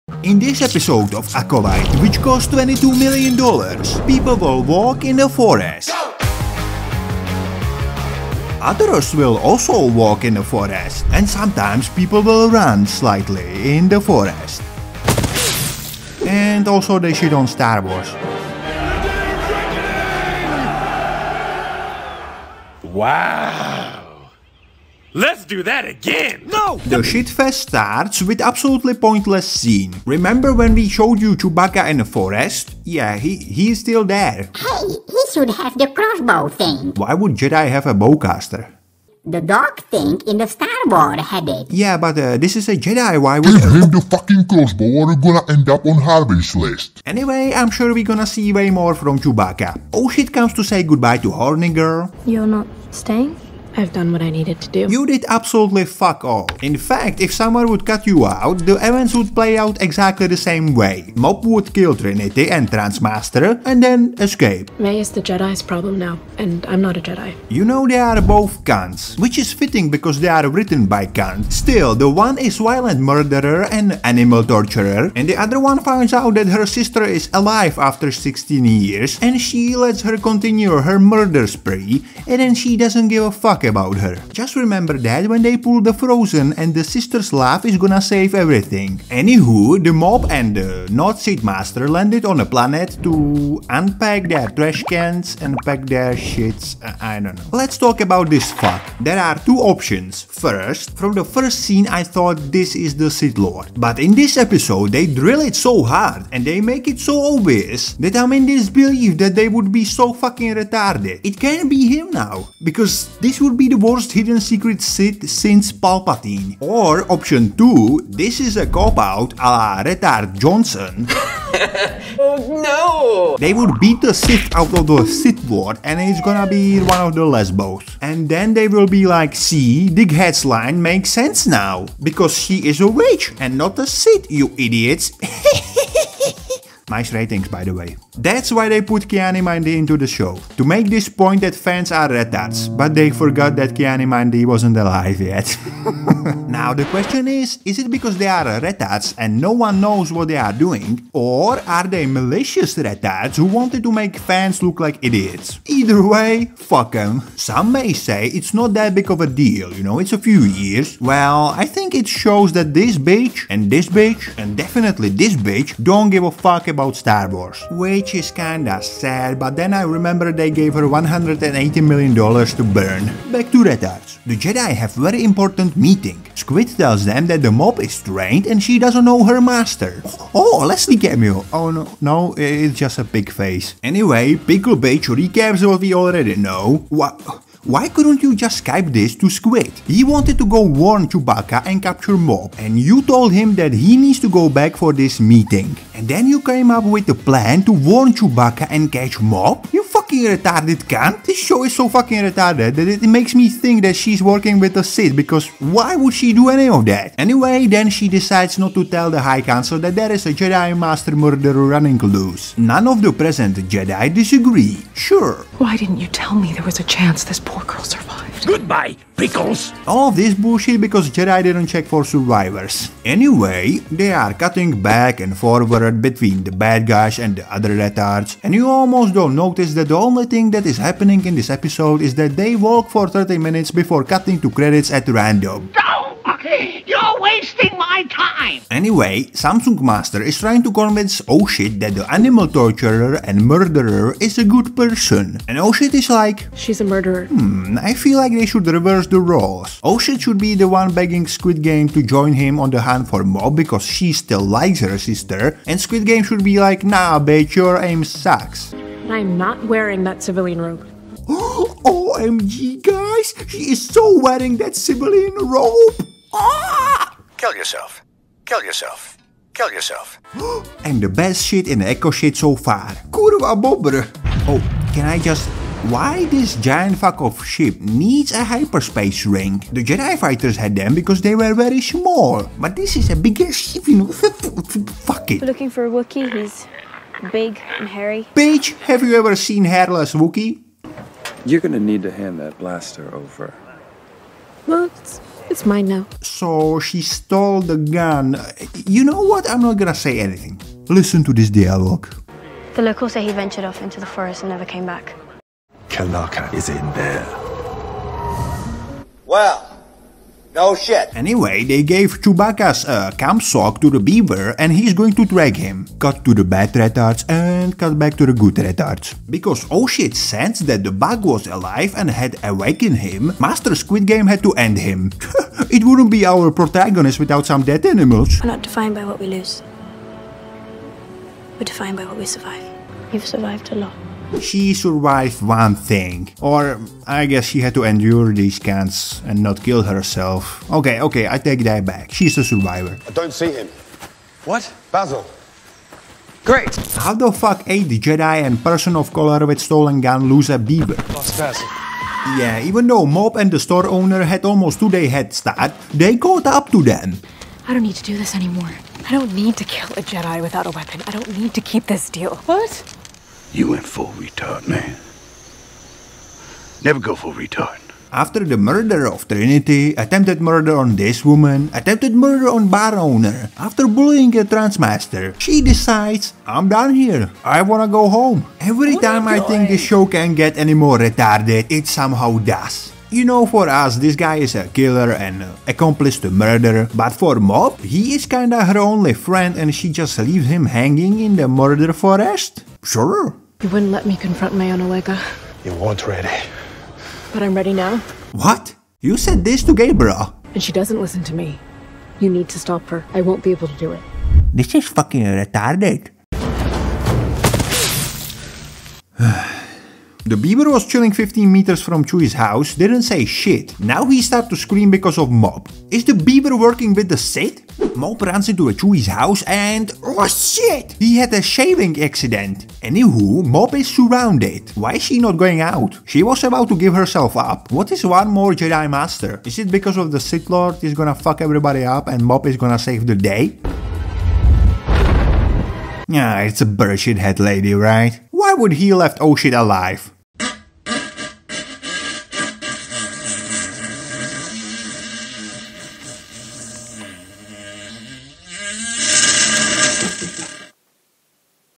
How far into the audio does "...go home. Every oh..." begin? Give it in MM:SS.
06:17.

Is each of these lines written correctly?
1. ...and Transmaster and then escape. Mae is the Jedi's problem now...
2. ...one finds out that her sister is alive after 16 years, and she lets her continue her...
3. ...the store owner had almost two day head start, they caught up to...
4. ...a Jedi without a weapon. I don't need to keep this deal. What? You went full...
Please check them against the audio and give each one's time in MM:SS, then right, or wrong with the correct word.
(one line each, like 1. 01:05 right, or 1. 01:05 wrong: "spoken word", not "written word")
1. 01:02 right
2. 01:15 right
3. 05:53 right
4. 05:59 right.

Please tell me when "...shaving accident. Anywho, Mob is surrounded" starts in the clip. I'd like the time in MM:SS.
07:01.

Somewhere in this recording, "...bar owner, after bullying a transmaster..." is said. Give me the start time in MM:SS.
06:12.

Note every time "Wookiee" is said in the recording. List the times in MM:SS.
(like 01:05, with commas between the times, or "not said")
04:45, 04:50.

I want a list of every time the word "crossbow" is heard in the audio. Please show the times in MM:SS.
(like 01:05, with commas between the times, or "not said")
00:35, 00:44.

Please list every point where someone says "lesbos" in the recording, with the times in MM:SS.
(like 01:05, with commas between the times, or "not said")
02:07.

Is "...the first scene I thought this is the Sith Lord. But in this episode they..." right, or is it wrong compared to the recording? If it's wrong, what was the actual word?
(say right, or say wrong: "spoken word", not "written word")
right.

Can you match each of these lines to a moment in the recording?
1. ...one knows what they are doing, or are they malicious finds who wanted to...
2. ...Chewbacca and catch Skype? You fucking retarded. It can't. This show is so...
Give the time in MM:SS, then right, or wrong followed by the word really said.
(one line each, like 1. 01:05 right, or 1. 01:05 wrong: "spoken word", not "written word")
1. 02:29 wrong: "retards", not "finds"
2. 03:18 wrong: "Mob", not "Skype".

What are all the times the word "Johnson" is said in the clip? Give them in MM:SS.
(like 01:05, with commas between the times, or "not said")
02:00.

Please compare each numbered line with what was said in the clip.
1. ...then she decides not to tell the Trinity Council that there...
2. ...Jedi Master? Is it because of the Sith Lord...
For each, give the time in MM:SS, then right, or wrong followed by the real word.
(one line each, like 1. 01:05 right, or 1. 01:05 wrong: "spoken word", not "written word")
1. 03:27 wrong: "High", not "Trinity"
2. 07:08 right.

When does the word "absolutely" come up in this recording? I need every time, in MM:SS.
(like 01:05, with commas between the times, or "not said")
00:28, 00:55.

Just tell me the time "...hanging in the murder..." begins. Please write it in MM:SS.
06:30.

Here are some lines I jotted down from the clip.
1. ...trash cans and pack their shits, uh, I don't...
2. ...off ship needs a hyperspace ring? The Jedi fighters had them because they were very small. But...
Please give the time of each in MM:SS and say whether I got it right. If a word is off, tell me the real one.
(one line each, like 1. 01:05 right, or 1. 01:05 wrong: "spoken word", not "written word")
1. 01:34 right
2. 04:37 right.